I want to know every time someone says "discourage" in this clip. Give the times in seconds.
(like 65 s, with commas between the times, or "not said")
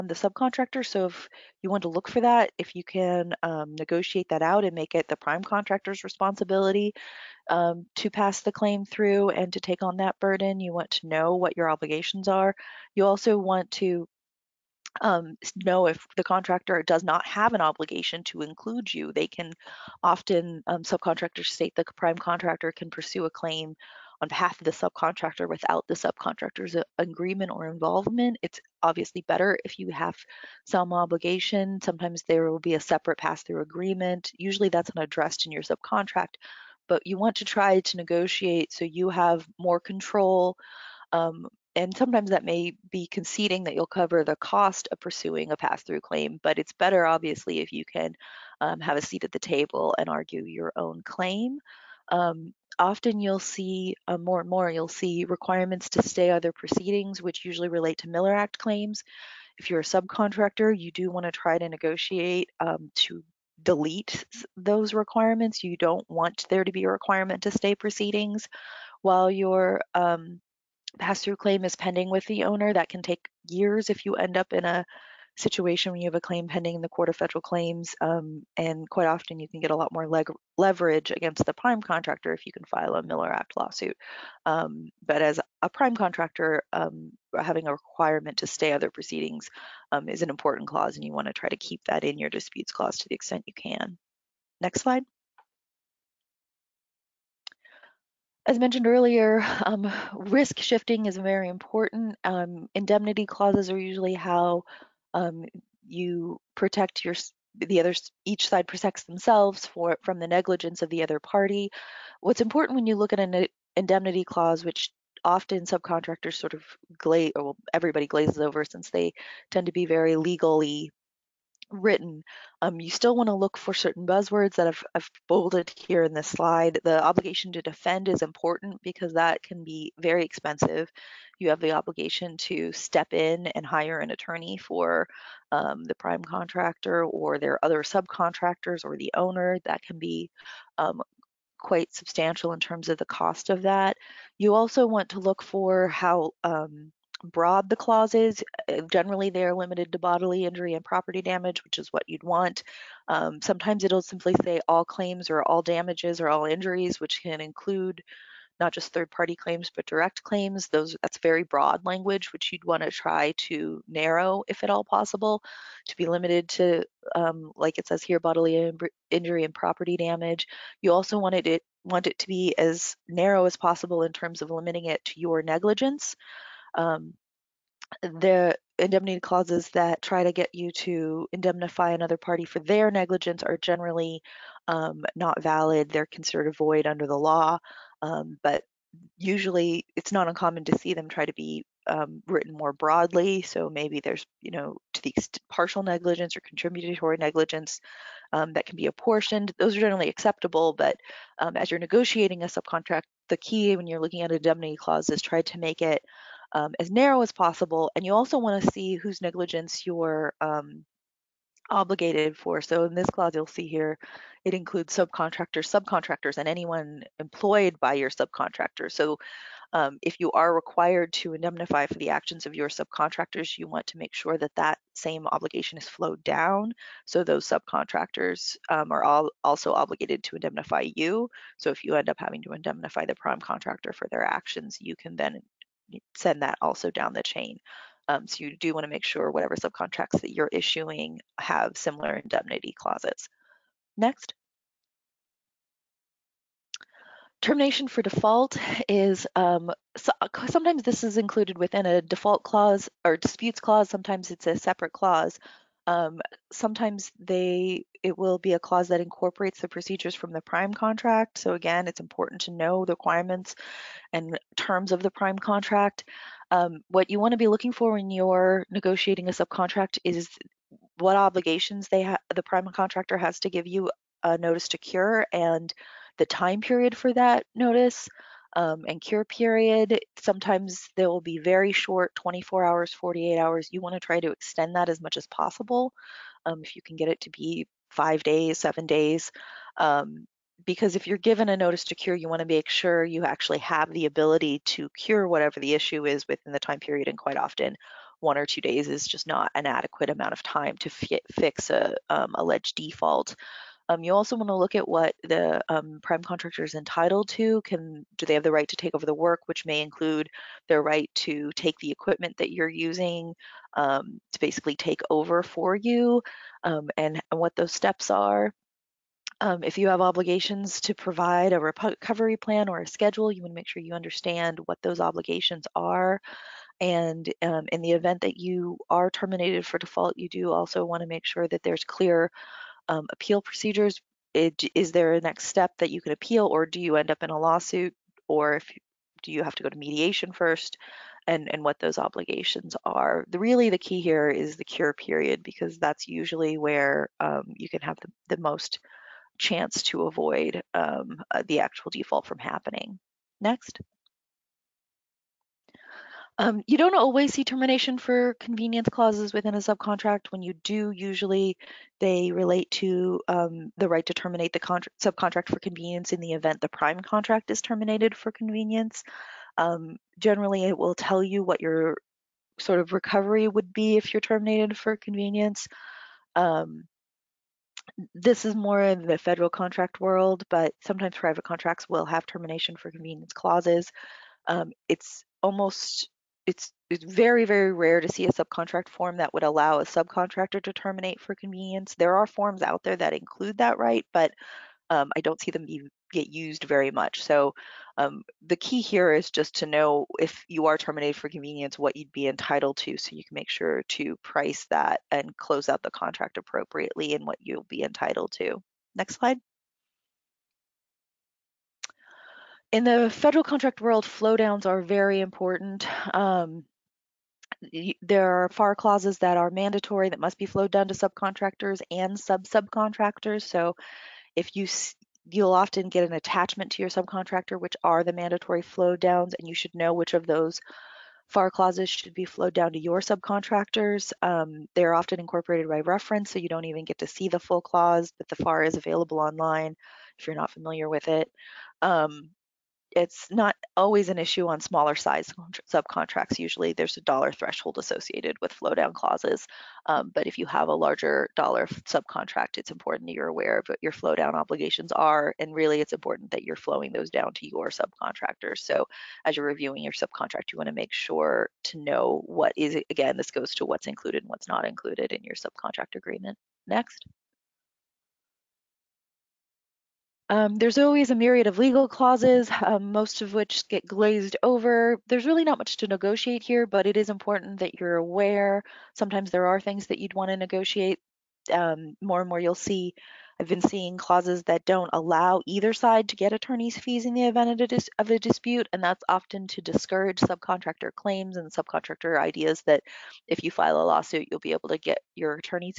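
489 s.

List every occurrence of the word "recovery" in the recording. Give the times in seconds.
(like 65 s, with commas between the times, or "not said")
321 s, 372 s.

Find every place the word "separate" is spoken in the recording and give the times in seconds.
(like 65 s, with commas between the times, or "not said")
32 s, 254 s.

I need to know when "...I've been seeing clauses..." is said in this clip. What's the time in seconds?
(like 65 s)
483 s.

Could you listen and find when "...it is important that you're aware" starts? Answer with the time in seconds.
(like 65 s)
476 s.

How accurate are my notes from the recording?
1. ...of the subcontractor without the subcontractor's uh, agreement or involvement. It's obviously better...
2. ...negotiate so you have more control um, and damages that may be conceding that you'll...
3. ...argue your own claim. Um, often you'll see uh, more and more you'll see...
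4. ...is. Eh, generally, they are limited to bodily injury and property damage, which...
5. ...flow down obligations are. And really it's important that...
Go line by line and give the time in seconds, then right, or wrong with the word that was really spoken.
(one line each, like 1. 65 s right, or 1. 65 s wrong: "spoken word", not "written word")
1. 24 s right
2. 37 s wrong: "sometimes", not "damages"
3. 50 s right
4. 148 s right
5. 453 s right.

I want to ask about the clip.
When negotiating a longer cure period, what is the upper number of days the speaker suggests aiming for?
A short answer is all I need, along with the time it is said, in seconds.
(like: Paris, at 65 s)
7 days, at 288 s.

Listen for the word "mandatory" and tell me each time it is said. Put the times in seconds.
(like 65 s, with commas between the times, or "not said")
419 s, 428 s.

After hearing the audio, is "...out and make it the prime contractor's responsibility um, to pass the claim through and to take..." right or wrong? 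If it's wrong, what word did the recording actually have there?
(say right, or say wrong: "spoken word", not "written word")
right.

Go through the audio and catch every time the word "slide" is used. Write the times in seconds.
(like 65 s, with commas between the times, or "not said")
94 s, 126 s, 409 s.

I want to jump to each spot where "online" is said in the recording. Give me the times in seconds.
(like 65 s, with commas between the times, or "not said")
439 s.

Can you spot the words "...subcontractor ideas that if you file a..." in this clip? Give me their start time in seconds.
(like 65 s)
491 s.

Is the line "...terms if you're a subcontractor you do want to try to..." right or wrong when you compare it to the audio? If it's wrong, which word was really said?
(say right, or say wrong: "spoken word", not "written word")
wrong: "claims", not "terms".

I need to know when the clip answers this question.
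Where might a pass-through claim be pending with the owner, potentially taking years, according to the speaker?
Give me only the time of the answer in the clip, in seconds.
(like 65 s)
76 s.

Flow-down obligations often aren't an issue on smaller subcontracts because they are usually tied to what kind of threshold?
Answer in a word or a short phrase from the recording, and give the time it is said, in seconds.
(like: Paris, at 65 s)
dollar threshold, at 447 s.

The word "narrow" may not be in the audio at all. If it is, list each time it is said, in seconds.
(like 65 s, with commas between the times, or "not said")
163 s, 173 s, 206 s.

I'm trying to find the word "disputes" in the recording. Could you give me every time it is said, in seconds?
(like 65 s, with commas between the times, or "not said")
92 s, 253 s, 488 s.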